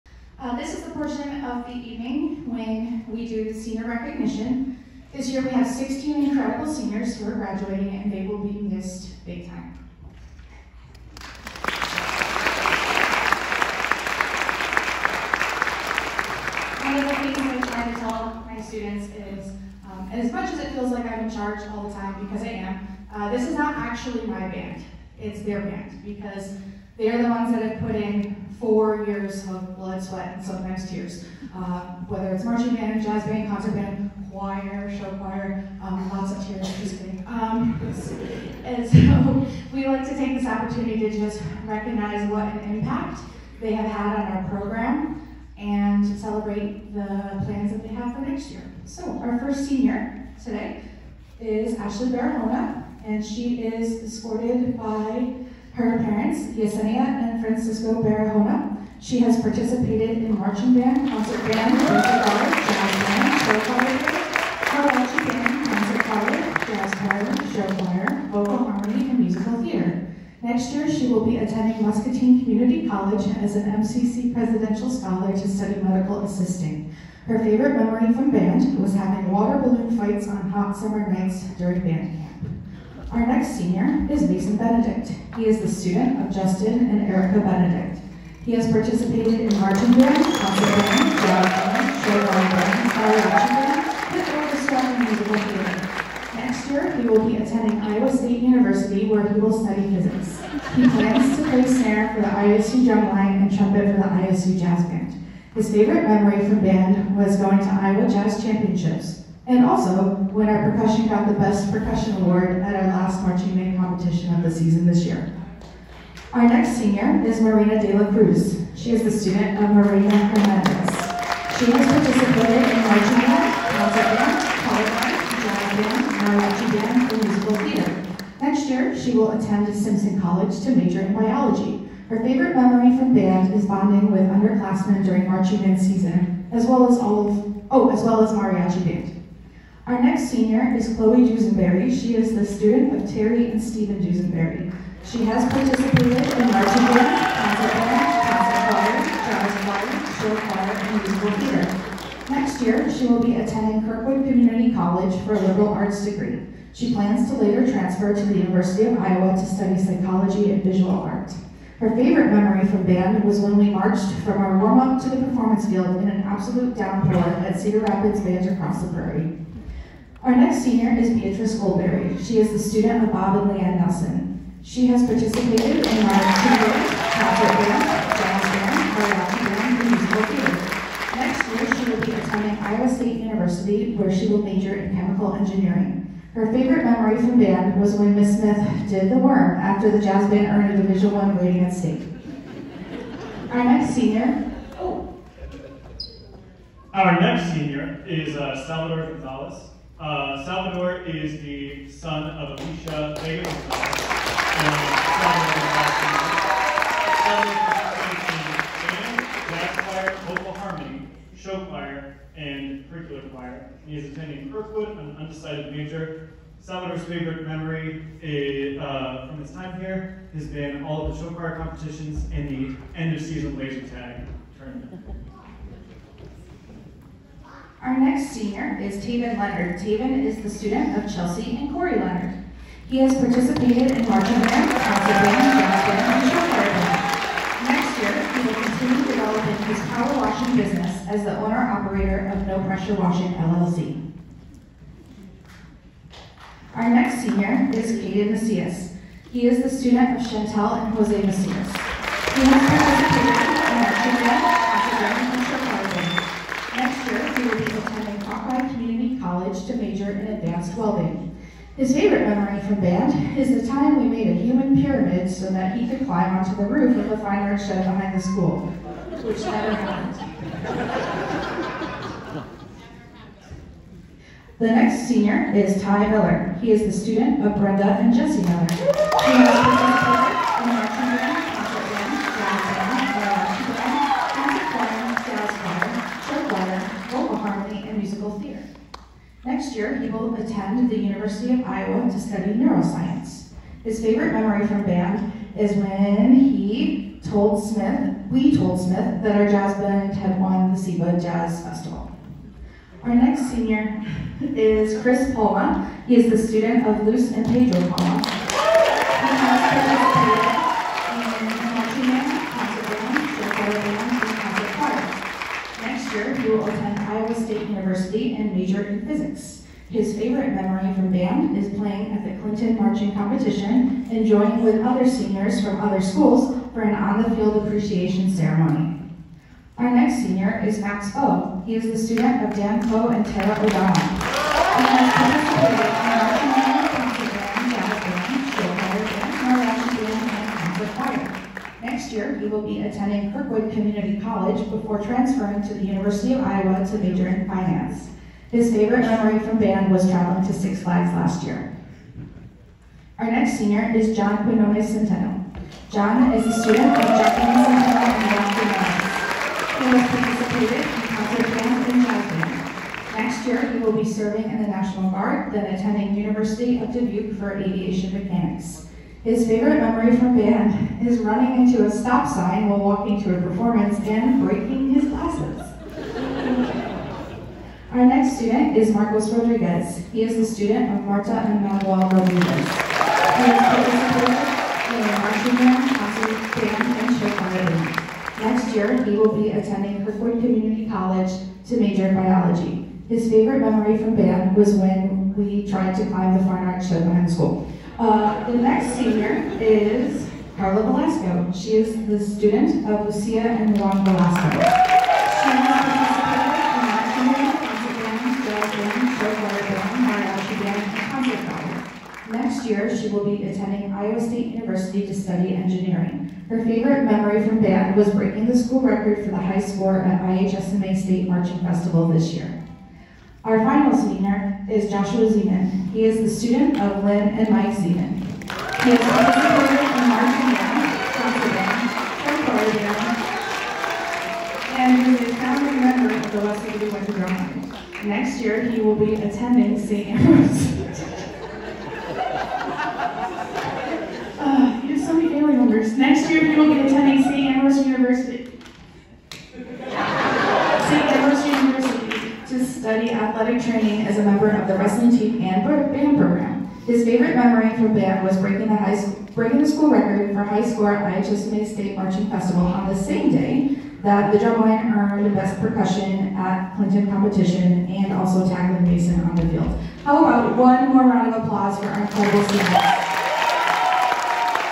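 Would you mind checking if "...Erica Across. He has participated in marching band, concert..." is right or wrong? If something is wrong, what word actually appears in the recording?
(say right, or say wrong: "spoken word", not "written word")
wrong: "Benedict", not "Across".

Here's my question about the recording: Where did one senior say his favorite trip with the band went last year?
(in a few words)
Six Flags.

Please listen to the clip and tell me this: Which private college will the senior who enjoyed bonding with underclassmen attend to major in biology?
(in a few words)
Simpson College.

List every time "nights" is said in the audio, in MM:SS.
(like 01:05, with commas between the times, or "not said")
01:21.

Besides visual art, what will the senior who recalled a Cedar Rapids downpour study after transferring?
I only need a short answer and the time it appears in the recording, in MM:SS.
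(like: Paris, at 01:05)
psychology, at 02:39.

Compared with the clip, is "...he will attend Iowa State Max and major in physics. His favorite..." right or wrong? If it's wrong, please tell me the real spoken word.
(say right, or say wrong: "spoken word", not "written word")
wrong: "University", not "Max".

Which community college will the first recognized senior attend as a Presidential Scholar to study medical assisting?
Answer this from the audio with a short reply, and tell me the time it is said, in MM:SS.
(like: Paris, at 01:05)
Muscatine Community College, at 01:11.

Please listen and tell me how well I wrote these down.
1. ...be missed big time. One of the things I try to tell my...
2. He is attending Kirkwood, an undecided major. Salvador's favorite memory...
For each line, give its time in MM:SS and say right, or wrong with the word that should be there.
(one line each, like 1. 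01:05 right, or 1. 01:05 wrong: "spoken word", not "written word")
1. 00:08 right
2. 03:33 right.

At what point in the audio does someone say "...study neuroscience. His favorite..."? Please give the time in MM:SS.
04:52.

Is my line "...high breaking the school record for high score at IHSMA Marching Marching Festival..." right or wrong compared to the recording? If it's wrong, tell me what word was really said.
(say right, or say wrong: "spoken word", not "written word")
wrong: "State", not "Marching".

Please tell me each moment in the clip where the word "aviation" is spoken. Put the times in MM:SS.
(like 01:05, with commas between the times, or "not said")
06:07.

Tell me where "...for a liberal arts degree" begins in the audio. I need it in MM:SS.
02:35.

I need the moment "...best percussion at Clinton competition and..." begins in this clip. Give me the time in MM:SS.
07:45.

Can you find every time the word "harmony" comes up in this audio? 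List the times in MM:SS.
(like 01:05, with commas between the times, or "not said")
01:08, 03:30.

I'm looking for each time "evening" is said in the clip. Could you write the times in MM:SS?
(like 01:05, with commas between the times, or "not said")
00:01.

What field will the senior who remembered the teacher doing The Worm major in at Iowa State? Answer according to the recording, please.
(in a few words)
chemical engineering.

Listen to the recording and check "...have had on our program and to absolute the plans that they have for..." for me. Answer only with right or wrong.
wrong.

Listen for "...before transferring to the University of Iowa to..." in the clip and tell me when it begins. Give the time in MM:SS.
05:44.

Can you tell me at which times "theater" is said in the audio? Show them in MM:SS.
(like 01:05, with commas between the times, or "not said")
01:09, 01:35, 02:07, 02:31, 03:00.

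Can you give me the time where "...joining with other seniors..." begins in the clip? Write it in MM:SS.
05:24.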